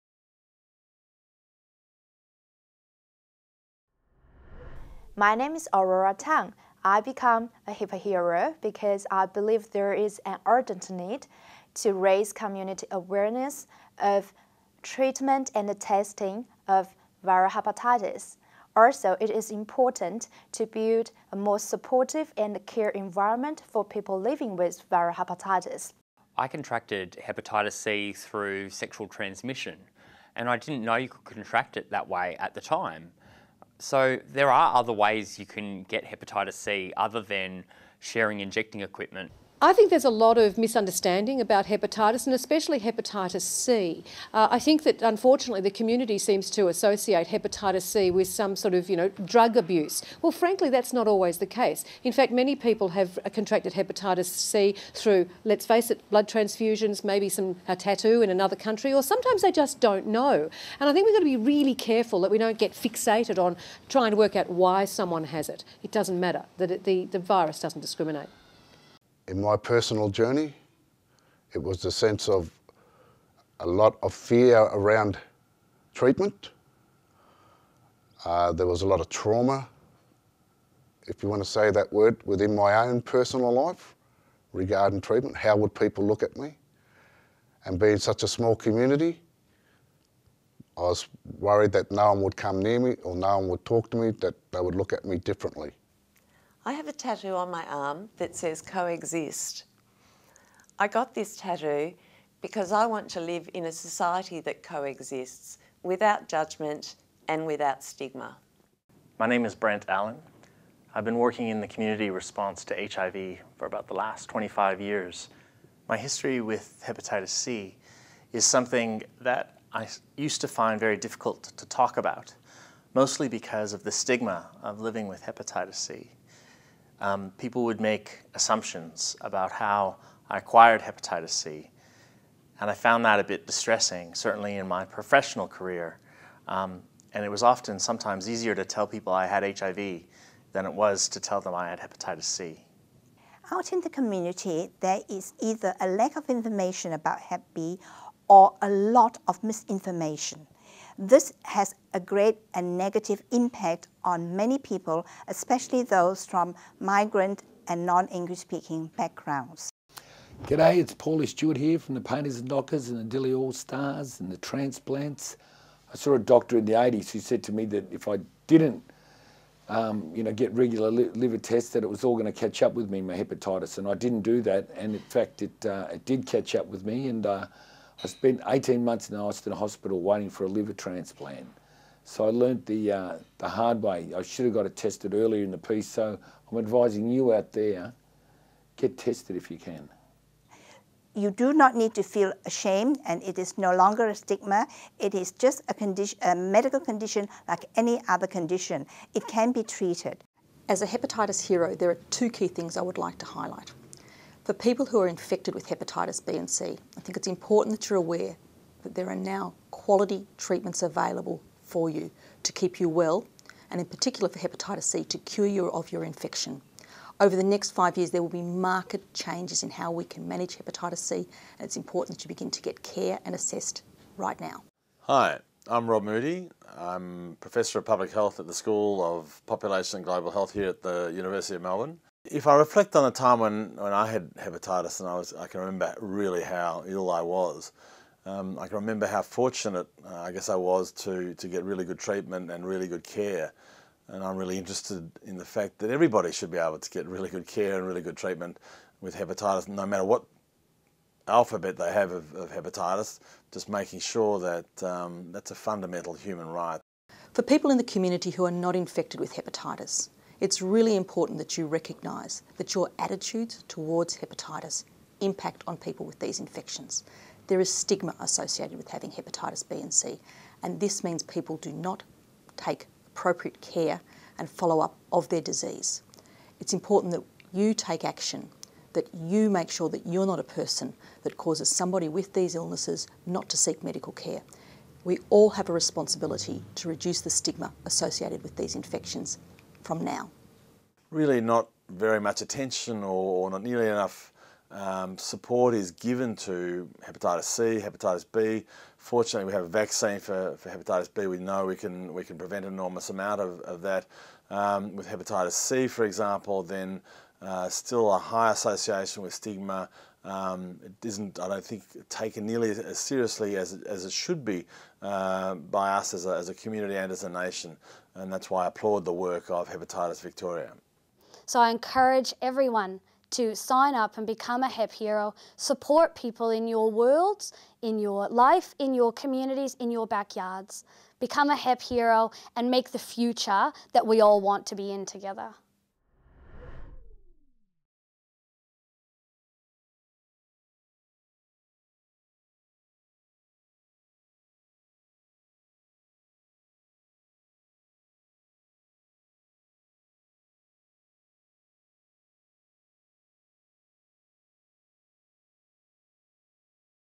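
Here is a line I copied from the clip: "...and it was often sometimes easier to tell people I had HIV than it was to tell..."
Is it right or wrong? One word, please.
right.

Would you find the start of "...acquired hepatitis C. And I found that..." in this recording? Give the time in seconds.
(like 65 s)
130 s.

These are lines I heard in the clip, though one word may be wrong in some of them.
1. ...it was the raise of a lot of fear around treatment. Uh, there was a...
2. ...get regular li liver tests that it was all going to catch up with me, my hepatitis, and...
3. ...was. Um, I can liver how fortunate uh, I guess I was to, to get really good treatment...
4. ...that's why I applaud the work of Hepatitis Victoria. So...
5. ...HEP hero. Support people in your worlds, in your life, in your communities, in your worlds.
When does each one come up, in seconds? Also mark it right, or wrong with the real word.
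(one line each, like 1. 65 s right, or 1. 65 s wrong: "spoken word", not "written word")
1. 71 s wrong: "sense", not "raise"
2. 170 s right
3. 237 s wrong: "remember", not "liver"
4. 318 s right
5. 324 s wrong: "backyards", not "worlds".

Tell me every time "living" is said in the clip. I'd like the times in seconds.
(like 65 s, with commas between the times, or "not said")
24 s, 124 s.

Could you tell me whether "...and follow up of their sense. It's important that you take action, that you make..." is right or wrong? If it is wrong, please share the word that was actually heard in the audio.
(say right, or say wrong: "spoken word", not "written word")
wrong: "disease", not "sense".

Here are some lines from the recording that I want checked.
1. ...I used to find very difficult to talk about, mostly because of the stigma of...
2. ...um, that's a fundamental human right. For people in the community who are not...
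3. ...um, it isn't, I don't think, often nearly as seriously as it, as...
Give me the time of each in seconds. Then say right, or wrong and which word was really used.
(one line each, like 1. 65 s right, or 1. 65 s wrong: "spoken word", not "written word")
1. 119 s right
2. 254 s right
3. 310 s wrong: "taken", not "often".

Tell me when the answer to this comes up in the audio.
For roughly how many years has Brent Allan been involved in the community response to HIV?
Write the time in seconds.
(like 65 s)
114 s.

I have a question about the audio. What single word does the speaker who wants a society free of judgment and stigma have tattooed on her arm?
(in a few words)
coexist.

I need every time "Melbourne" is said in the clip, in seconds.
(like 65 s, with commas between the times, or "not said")
231 s.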